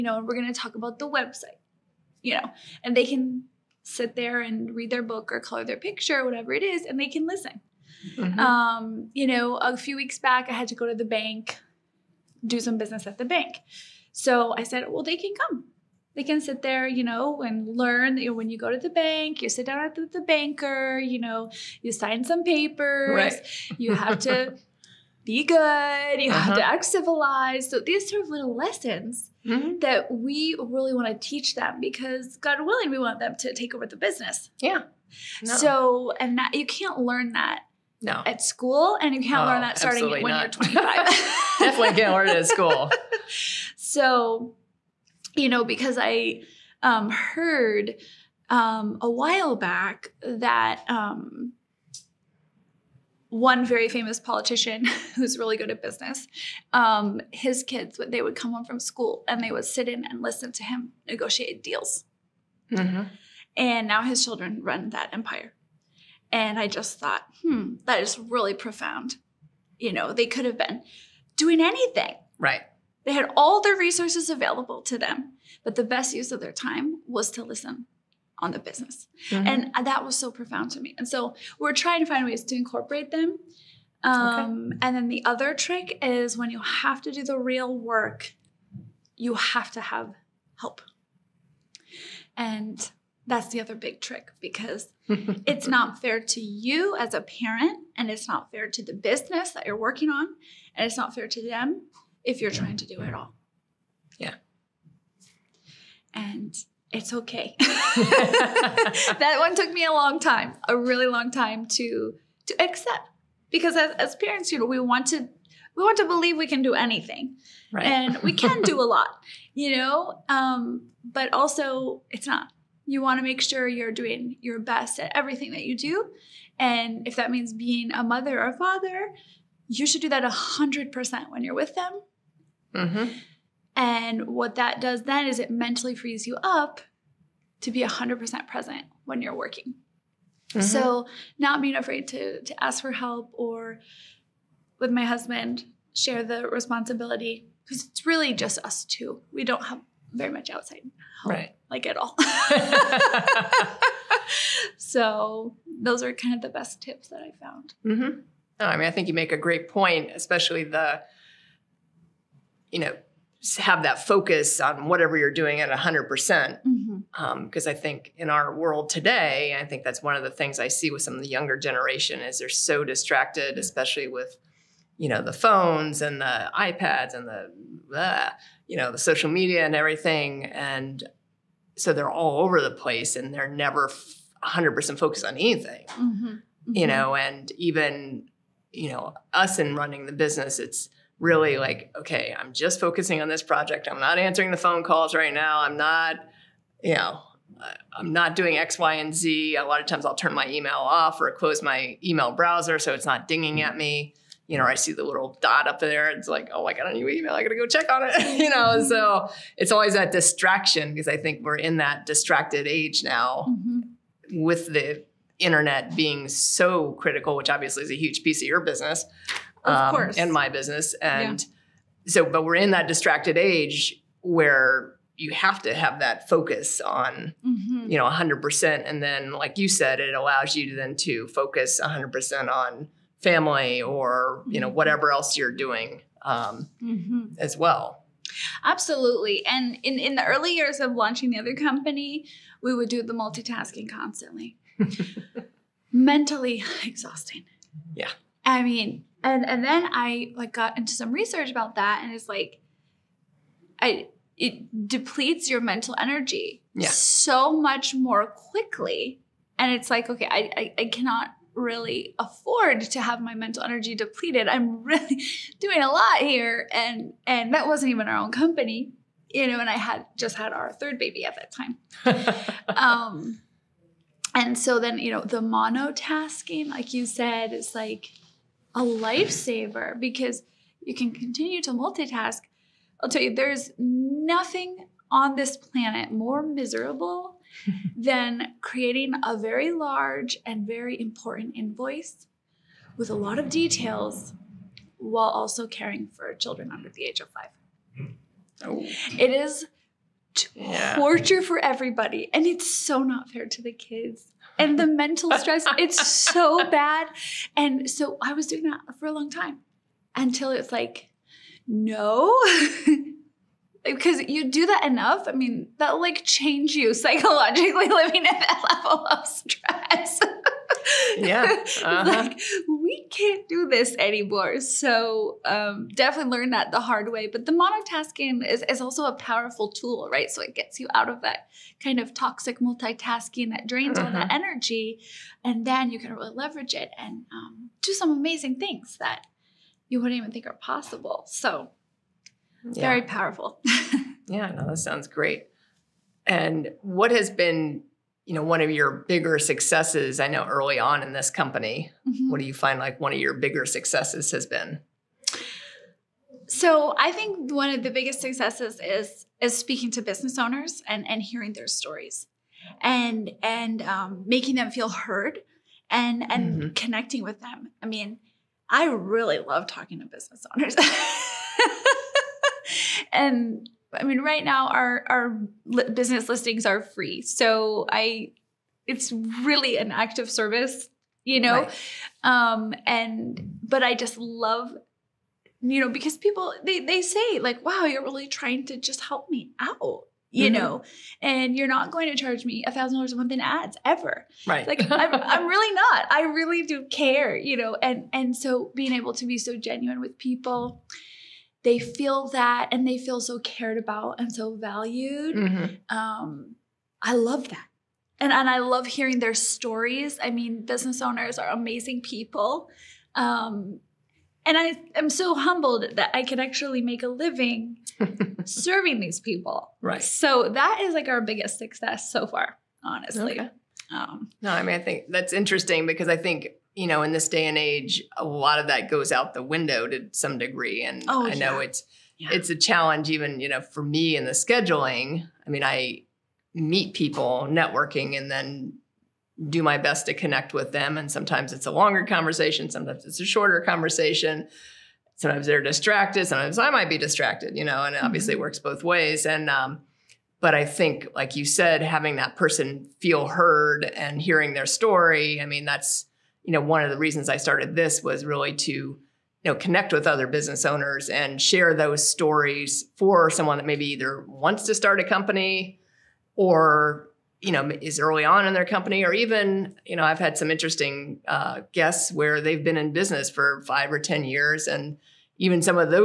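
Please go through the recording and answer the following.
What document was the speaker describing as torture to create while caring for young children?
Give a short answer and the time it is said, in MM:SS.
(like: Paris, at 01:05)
Invoice, at 04:51.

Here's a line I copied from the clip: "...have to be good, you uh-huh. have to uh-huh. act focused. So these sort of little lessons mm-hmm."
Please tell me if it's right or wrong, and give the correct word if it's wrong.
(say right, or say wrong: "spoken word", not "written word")
wrong: "civilized", not "focused".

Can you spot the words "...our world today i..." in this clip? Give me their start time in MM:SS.
02:48.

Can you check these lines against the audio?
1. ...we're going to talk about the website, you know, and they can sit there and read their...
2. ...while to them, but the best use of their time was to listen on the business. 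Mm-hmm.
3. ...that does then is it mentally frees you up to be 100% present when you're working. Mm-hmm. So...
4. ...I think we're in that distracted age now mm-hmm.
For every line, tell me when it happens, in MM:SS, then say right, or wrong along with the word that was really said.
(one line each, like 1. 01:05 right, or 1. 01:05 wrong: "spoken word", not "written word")
1. 00:00 right
2. 01:14 wrong: "available", not "while"
3. 02:14 right
4. 03:31 right.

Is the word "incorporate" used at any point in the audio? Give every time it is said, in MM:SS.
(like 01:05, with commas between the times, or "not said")
01:22.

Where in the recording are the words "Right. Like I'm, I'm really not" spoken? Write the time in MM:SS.
06:34.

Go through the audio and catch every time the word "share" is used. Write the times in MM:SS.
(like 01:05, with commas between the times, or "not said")
02:25, 07:41.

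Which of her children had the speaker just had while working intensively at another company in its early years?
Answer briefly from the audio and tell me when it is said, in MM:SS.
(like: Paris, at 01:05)
Third baby, at 04:30.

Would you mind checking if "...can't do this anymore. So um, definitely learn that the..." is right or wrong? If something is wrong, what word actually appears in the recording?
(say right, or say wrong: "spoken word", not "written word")
right.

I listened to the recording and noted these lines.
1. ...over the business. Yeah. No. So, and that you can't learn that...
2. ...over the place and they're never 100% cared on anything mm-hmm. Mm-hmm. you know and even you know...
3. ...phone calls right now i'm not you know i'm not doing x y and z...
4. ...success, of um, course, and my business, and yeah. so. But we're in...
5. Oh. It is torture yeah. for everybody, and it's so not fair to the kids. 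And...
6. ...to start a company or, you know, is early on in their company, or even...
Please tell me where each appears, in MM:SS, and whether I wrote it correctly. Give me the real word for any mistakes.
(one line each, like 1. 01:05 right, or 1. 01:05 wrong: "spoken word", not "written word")
1. 00:33 right
2. 03:02 wrong: "focused", not "cared"
3. 03:14 right
4. 03:38 wrong: "business", not "success"
5. 04:58 right
6. 07:44 right.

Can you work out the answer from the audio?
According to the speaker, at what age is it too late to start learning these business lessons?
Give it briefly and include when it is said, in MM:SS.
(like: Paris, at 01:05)
25, at 00:40.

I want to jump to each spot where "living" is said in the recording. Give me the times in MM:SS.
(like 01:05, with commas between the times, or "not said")
05:17, 06:57.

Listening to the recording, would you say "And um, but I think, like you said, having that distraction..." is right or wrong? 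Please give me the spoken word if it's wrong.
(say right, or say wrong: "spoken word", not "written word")
wrong: "person", not "distraction".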